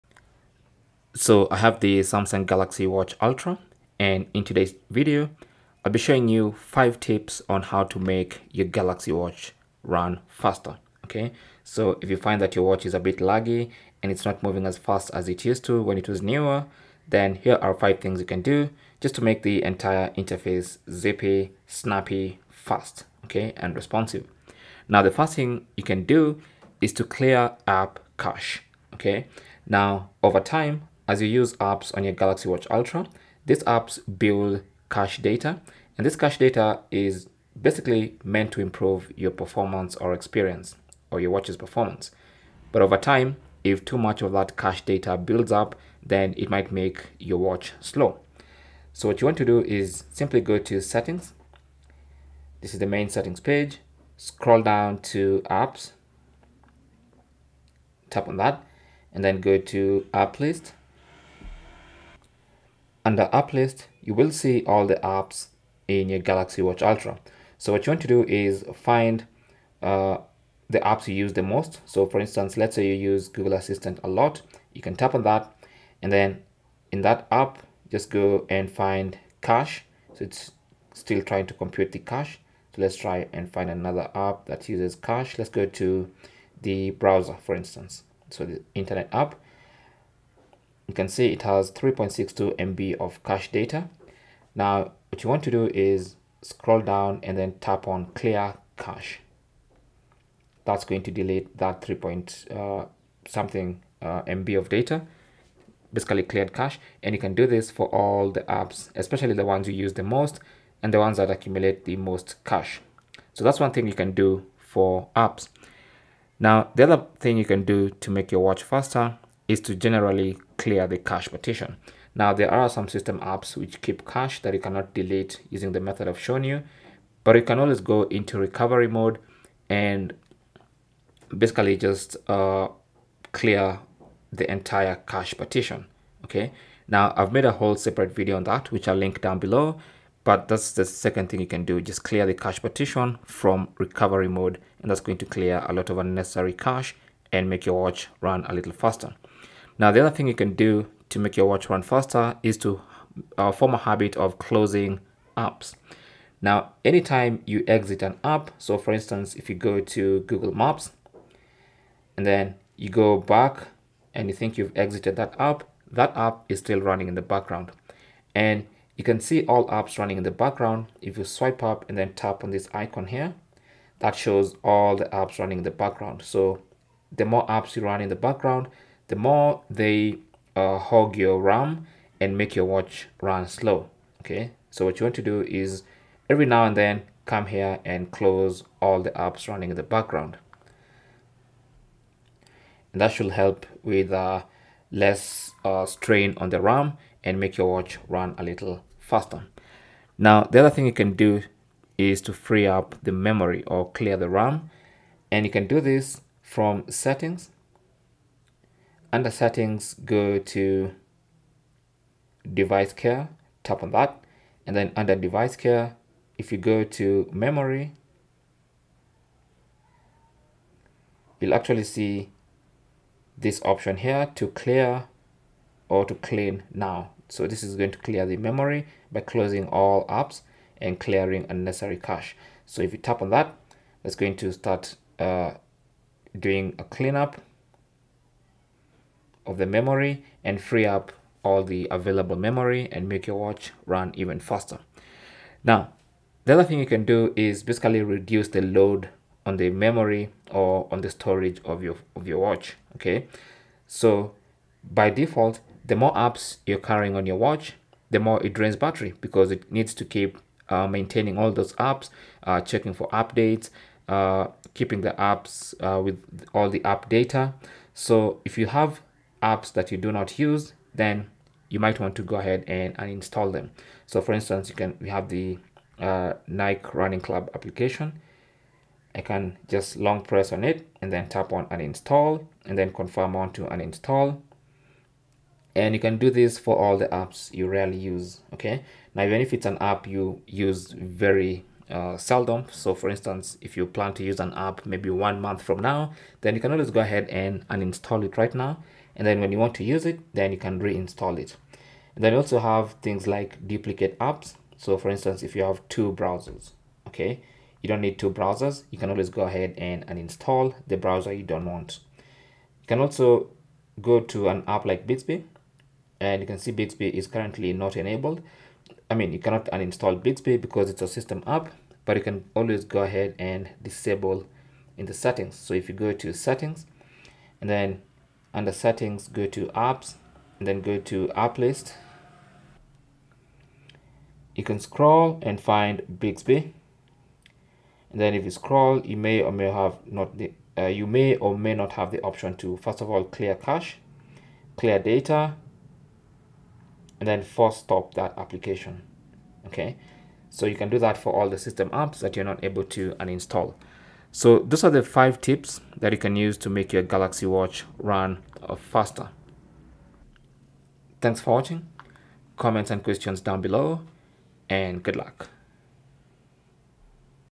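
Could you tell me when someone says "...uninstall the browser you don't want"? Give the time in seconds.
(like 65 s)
310 s.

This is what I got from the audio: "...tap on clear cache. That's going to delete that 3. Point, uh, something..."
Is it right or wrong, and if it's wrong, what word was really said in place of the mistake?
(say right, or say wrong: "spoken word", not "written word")
right.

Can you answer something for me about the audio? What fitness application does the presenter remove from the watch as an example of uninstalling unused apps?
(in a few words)
Nike Running Club.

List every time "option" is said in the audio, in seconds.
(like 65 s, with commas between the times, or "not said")
223 s, 342 s.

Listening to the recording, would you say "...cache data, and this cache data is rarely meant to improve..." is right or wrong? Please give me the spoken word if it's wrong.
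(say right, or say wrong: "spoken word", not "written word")
wrong: "basically", not "rarely".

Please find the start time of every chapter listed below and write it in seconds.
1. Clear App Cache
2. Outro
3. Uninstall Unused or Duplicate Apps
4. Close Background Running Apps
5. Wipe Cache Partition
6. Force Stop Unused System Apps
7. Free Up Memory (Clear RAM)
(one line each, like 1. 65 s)
1. 25 s
2. 354 s
3. 245 s
4. 149 s
5. 116 s
6. 313 s
7. 200 s.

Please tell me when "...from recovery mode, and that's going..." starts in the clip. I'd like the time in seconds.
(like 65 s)
143 s.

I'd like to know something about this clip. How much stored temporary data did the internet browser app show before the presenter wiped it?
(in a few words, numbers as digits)
3.62 MB.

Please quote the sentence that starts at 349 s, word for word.
Okay, so you can do that for all the system apps that you're not able to uninstall.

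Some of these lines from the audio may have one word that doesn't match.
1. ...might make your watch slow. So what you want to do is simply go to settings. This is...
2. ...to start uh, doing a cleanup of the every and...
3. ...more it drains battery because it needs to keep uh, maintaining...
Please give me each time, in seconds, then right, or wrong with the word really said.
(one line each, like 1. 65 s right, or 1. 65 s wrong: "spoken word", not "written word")
1. 46 s right
2. 234 s wrong: "memory", not "every"
3. 258 s right.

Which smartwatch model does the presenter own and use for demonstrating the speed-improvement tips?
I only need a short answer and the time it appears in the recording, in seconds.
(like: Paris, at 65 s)
Samsung Galaxy Watch Ultra, at 1 s.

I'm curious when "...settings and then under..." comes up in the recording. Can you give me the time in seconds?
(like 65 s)
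326 s.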